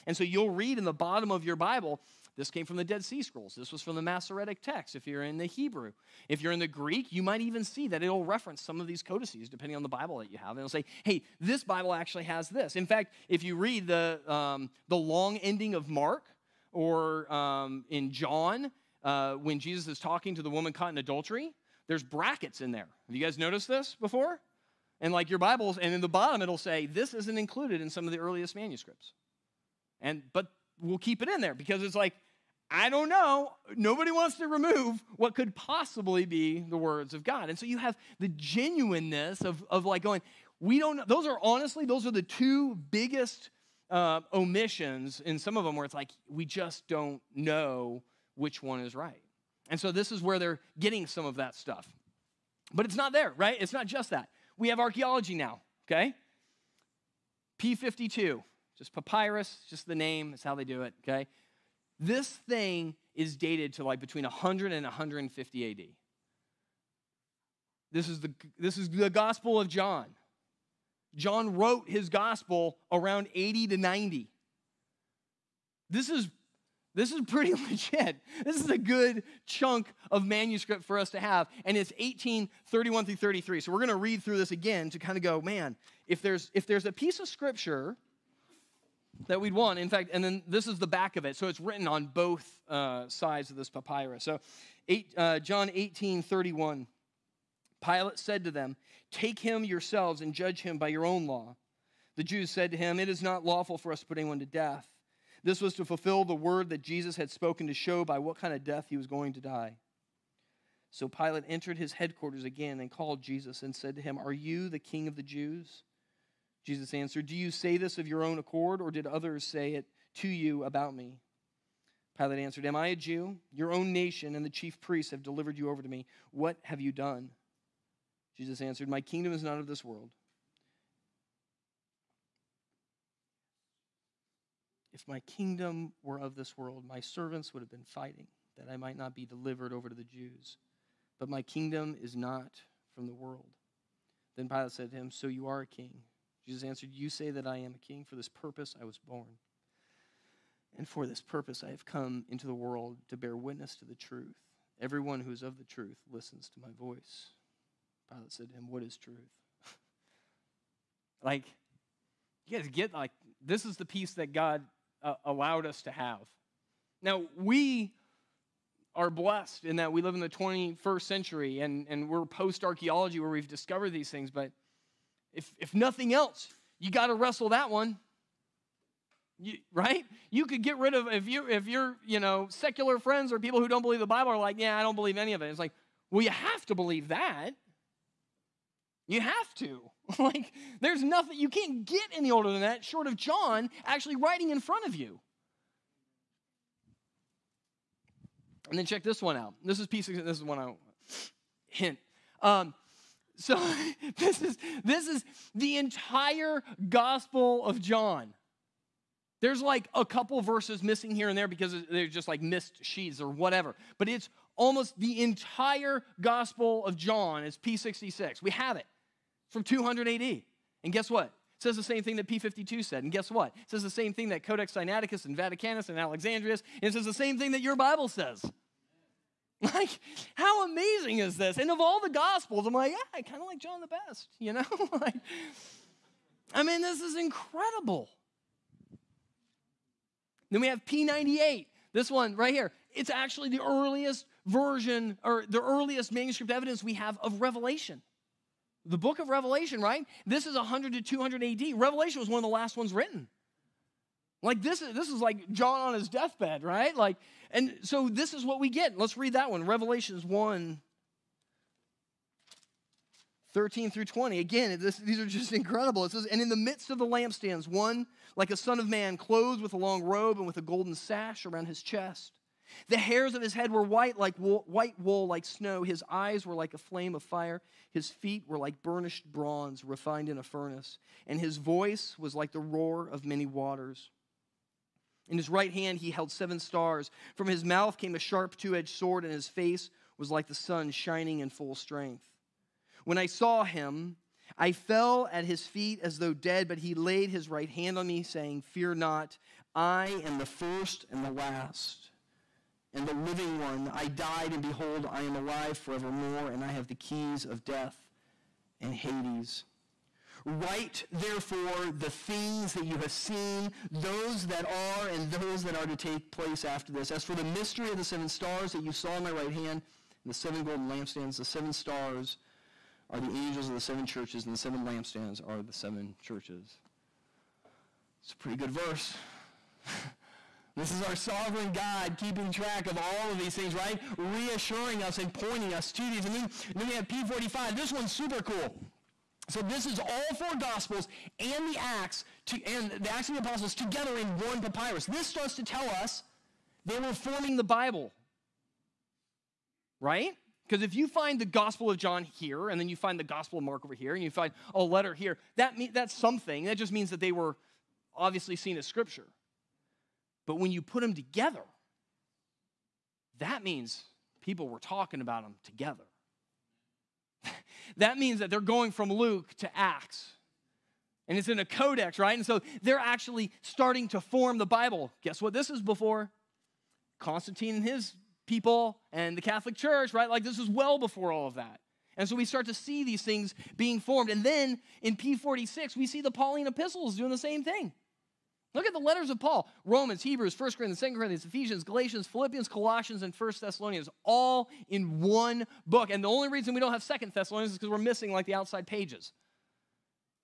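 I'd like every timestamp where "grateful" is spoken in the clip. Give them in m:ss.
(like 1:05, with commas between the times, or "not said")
not said.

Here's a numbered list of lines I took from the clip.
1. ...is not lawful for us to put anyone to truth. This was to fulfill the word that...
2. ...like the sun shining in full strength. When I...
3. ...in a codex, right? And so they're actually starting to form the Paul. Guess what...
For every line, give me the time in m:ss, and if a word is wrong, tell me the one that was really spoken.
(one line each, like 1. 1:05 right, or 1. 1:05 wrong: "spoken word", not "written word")
1. 1:43 wrong: "death", not "truth"
2. 4:50 right
3. 6:11 wrong: "Bible", not "Paul".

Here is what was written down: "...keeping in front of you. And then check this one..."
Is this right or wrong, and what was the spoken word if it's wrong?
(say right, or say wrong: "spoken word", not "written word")
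wrong: "writing", not "keeping".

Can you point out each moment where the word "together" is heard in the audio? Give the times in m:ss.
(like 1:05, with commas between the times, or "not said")
5:43, 6:01, 6:05.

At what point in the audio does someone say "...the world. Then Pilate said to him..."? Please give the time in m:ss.
2:23.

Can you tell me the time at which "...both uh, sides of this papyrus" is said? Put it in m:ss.
1:32.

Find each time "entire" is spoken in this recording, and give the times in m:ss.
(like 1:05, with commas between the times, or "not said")
3:25, 3:35.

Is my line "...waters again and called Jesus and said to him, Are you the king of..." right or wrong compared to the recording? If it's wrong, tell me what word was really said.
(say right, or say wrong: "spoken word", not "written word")
wrong: "headquarters", not "waters".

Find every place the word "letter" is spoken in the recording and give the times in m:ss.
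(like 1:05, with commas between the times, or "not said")
5:54, 6:28.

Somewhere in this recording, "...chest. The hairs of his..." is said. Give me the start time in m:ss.
4:31.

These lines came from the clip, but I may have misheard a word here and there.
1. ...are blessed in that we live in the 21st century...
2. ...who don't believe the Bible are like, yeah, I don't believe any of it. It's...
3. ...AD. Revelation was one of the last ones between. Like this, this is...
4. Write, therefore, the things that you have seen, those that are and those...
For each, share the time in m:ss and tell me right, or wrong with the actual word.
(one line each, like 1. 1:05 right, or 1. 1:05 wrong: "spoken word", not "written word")
1. 2:48 right
2. 3:03 right
3. 4:11 wrong: "written", not "between"
4. 5:10 right.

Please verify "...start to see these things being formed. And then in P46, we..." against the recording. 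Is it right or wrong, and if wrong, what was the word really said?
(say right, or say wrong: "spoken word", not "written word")
right.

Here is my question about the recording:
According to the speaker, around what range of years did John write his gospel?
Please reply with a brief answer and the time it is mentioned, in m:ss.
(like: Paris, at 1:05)
80 to 90, at 1:13.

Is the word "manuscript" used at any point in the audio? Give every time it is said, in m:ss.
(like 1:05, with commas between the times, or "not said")
0:28, 1:20, 4:06.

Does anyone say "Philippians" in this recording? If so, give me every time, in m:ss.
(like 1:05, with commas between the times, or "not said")
6:32.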